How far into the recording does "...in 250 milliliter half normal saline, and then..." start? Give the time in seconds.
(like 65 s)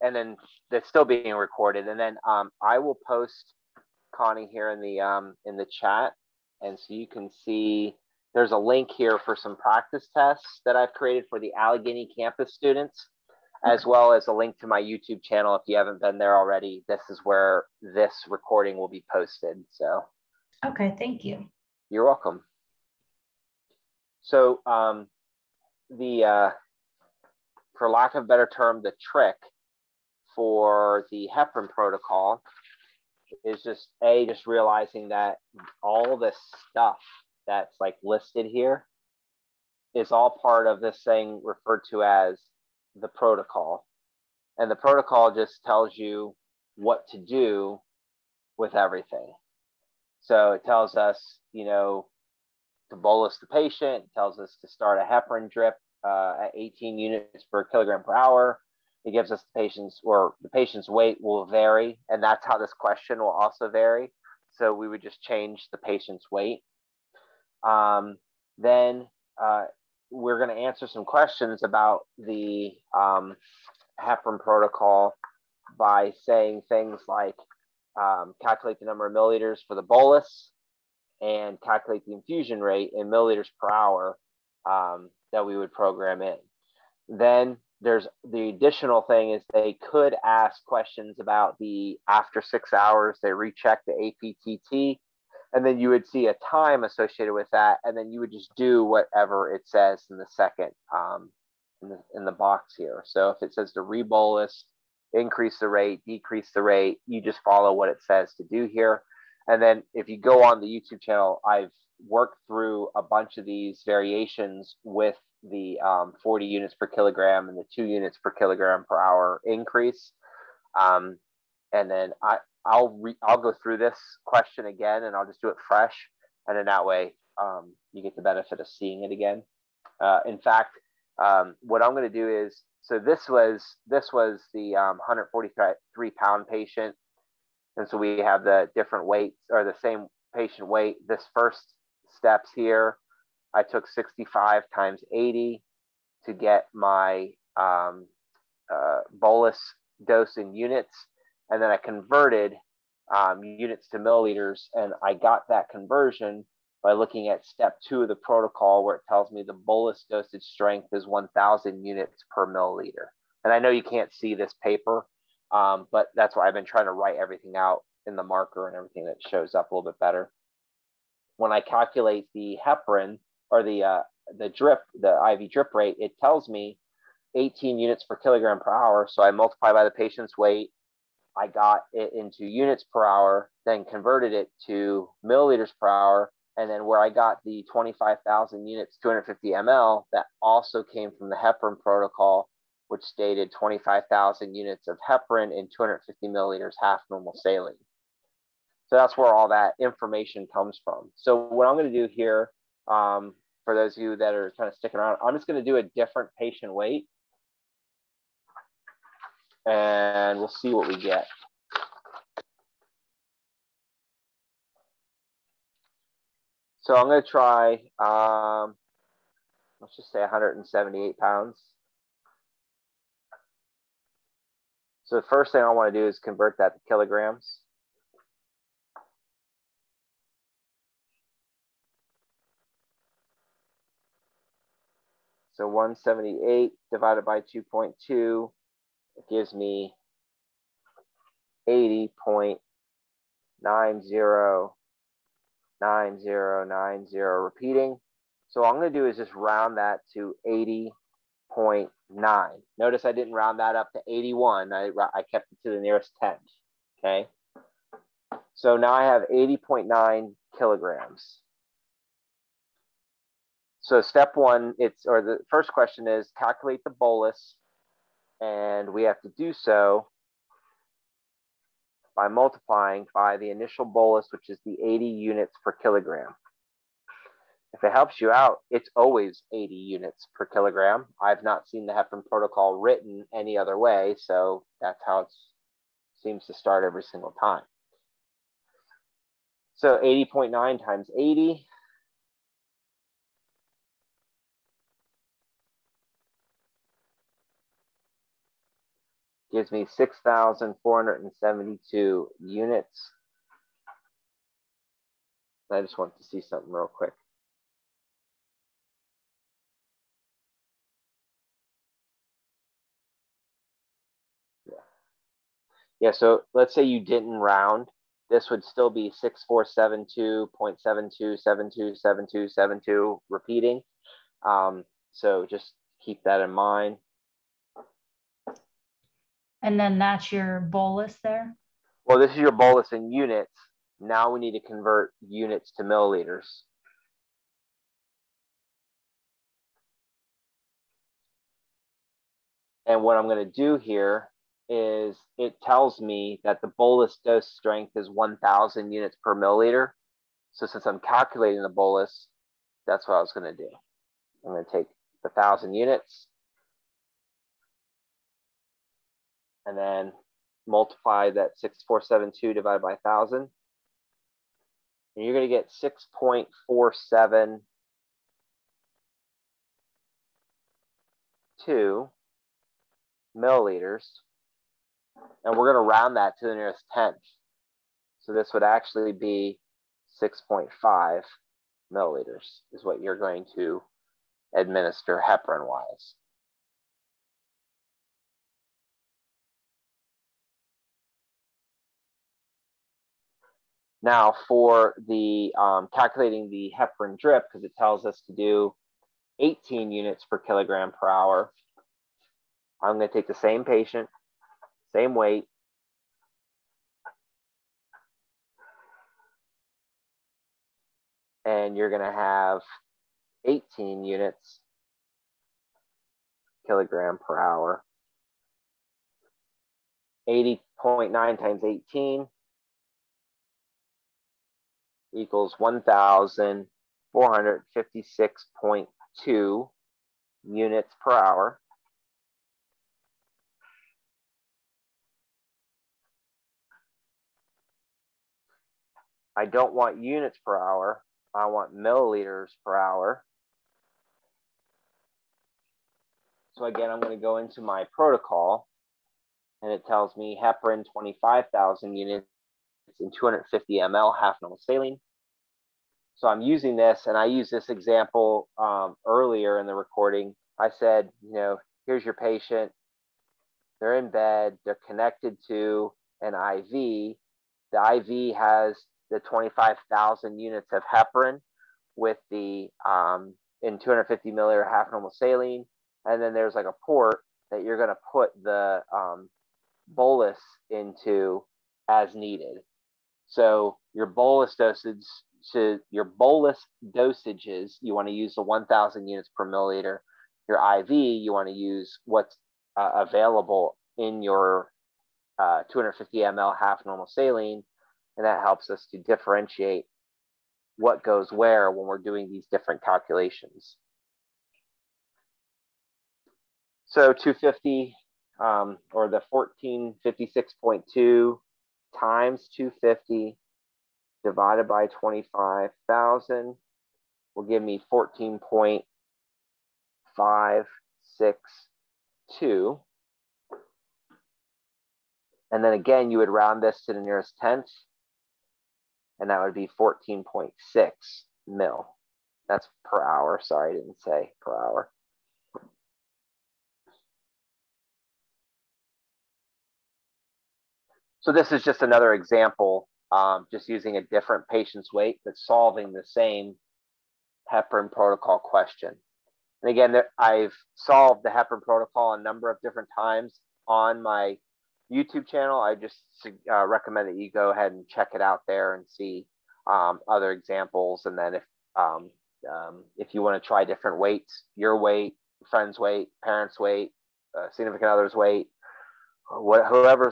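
473 s.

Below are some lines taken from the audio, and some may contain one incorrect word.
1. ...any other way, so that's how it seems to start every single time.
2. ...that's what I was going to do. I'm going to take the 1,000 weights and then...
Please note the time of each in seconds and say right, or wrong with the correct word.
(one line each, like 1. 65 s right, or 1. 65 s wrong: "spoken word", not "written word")
1. 283 s right
2. 352 s wrong: "units", not "weights".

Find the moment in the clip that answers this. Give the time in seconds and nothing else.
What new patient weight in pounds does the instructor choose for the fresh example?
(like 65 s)
220 s.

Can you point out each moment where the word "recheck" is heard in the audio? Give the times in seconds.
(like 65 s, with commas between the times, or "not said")
93 s.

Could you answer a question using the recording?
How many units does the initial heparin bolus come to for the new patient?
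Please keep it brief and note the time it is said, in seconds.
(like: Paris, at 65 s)
6,472 units, at 299 s.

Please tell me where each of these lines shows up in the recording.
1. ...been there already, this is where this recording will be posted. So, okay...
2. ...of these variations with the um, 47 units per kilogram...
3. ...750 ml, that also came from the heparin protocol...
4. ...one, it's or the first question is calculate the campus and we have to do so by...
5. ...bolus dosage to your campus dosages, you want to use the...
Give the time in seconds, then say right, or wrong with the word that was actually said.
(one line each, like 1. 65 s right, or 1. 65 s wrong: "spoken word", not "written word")
1. 16 s right
2. 113 s wrong: "40", not "47"
3. 189 s wrong: "250", not "750"
4. 264 s wrong: "bolus", not "campus"
5. 484 s wrong: "bolus", not "campus".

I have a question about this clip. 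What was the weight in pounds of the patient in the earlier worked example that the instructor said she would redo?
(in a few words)
143 pounds.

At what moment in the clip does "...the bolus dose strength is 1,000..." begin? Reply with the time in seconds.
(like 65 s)
346 s.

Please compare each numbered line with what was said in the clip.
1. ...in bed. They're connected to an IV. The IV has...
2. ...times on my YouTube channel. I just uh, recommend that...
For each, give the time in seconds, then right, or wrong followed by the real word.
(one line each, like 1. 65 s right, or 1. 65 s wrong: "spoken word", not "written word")
1. 463 s right
2. 552 s right.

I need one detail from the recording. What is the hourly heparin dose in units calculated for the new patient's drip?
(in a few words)
1,456.2 units per hour.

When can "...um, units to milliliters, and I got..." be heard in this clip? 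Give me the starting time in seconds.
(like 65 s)
153 s.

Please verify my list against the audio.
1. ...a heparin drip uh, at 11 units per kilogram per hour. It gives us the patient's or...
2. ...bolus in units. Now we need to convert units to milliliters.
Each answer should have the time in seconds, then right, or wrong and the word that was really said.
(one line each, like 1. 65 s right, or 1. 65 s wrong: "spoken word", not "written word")
1. 54 s wrong: "18", not "11"
2. 332 s right.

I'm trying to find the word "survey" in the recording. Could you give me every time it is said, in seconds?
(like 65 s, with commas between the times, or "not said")
not said.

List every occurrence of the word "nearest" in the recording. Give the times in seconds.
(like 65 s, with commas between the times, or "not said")
255 s, 376 s, 527 s.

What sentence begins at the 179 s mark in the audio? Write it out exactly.
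So I multiply by the patient's weight I got it into units per hour, then converted it to milliliters per hour.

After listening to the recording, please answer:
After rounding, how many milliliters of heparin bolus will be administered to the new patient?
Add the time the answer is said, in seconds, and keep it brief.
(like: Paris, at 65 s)
6.5 milliliters, at 380 s.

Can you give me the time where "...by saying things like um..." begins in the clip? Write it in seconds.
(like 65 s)
75 s.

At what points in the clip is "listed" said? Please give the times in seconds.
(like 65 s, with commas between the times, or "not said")
38 s.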